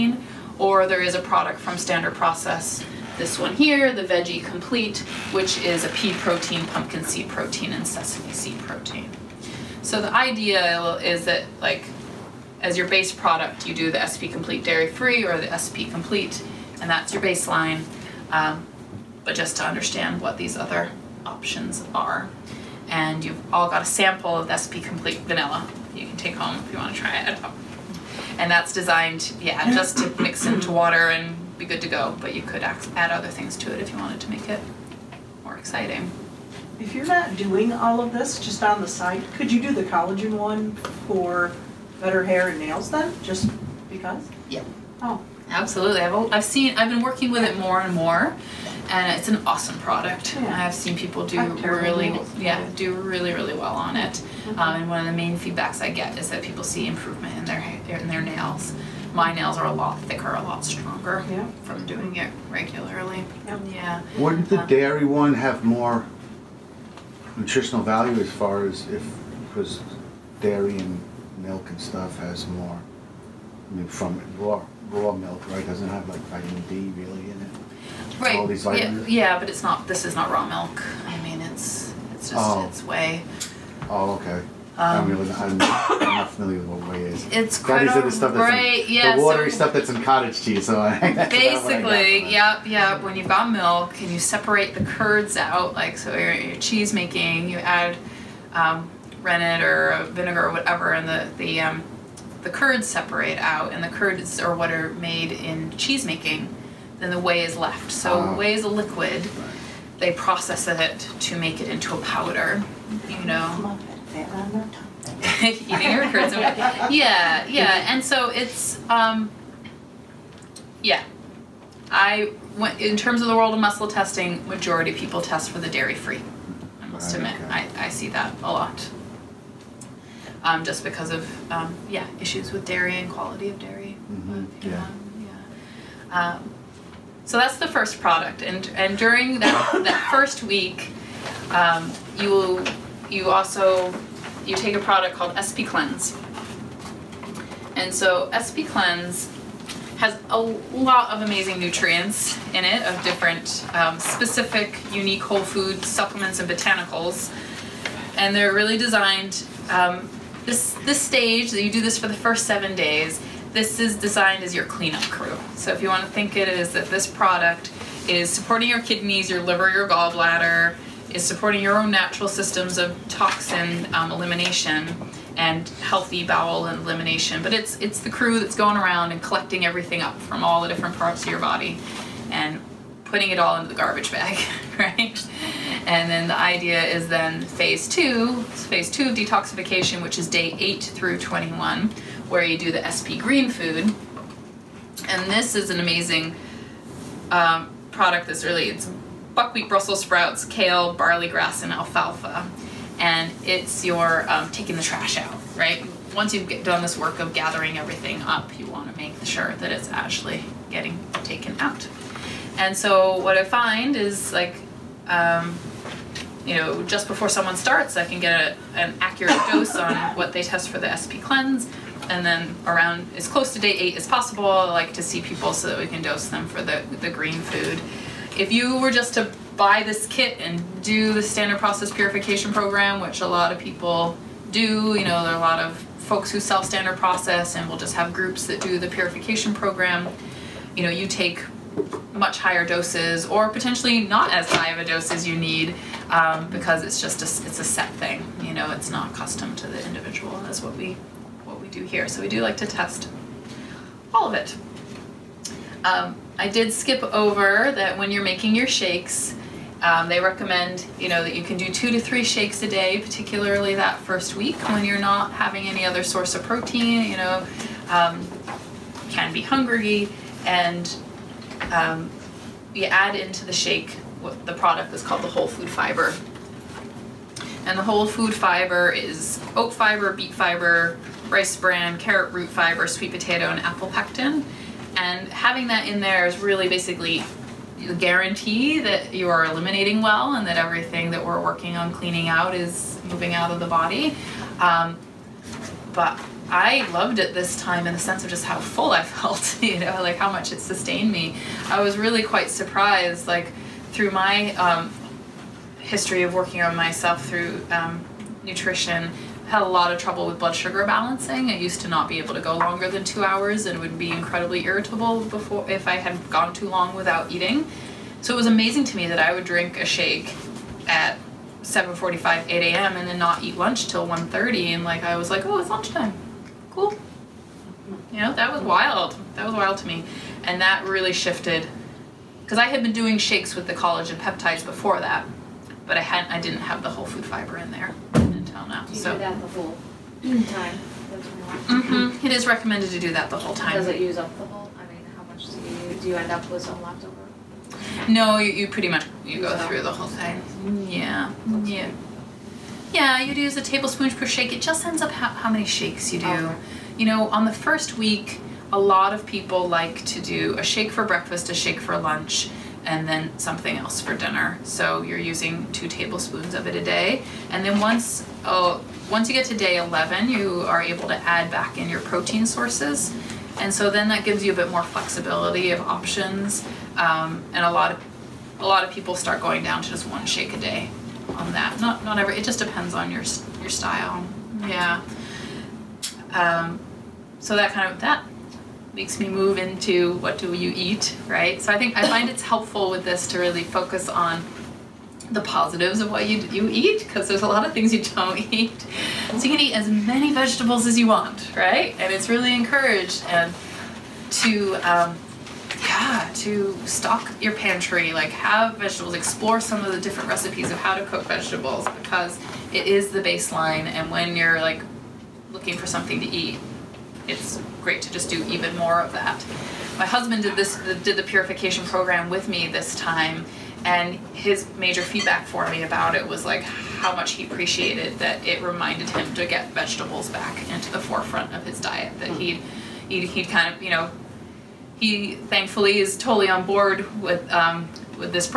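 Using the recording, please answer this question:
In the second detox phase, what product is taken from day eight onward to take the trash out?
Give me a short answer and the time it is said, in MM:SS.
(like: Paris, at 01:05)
SP Green Food, at 03:12.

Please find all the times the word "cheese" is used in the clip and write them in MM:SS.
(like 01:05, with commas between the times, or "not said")
01:30, 01:36, 01:45.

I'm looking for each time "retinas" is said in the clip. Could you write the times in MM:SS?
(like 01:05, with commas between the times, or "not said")
not said.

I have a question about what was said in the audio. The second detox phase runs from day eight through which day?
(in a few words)
21.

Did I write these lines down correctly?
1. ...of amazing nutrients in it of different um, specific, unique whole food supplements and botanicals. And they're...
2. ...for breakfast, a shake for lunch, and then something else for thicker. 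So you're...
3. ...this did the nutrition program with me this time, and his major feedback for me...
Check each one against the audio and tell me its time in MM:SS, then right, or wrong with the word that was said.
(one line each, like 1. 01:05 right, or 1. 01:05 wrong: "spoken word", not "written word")
1. 02:31 right
2. 06:00 wrong: "dinner", not "thicker"
3. 07:00 wrong: "purification", not "nutrition".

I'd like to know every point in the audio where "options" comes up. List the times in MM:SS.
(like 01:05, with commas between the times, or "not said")
00:21, 06:15.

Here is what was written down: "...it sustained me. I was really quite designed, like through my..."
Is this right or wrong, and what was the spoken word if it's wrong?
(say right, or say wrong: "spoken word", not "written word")
wrong: "surprised", not "designed".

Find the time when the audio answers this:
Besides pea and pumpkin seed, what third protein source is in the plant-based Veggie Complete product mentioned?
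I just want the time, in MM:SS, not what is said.
00:07.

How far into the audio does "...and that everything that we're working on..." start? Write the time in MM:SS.
04:50.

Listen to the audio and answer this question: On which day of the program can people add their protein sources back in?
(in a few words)
day 11.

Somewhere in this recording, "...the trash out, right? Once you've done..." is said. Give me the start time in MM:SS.
03:24.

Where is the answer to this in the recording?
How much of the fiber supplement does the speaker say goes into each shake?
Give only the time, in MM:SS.
05:53.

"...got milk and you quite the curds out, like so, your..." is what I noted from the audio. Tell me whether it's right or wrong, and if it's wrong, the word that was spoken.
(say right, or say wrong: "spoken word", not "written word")
wrong: "separate", not "quite".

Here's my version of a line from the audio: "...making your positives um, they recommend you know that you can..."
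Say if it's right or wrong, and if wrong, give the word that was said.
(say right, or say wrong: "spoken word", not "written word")
wrong: "shakes", not "positives".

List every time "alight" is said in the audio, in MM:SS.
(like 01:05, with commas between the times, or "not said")
not said.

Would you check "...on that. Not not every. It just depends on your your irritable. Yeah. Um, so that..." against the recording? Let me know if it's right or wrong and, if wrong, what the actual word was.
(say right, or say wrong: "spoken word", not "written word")
wrong: "style", not "irritable".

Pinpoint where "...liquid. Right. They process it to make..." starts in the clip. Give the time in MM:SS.
01:48.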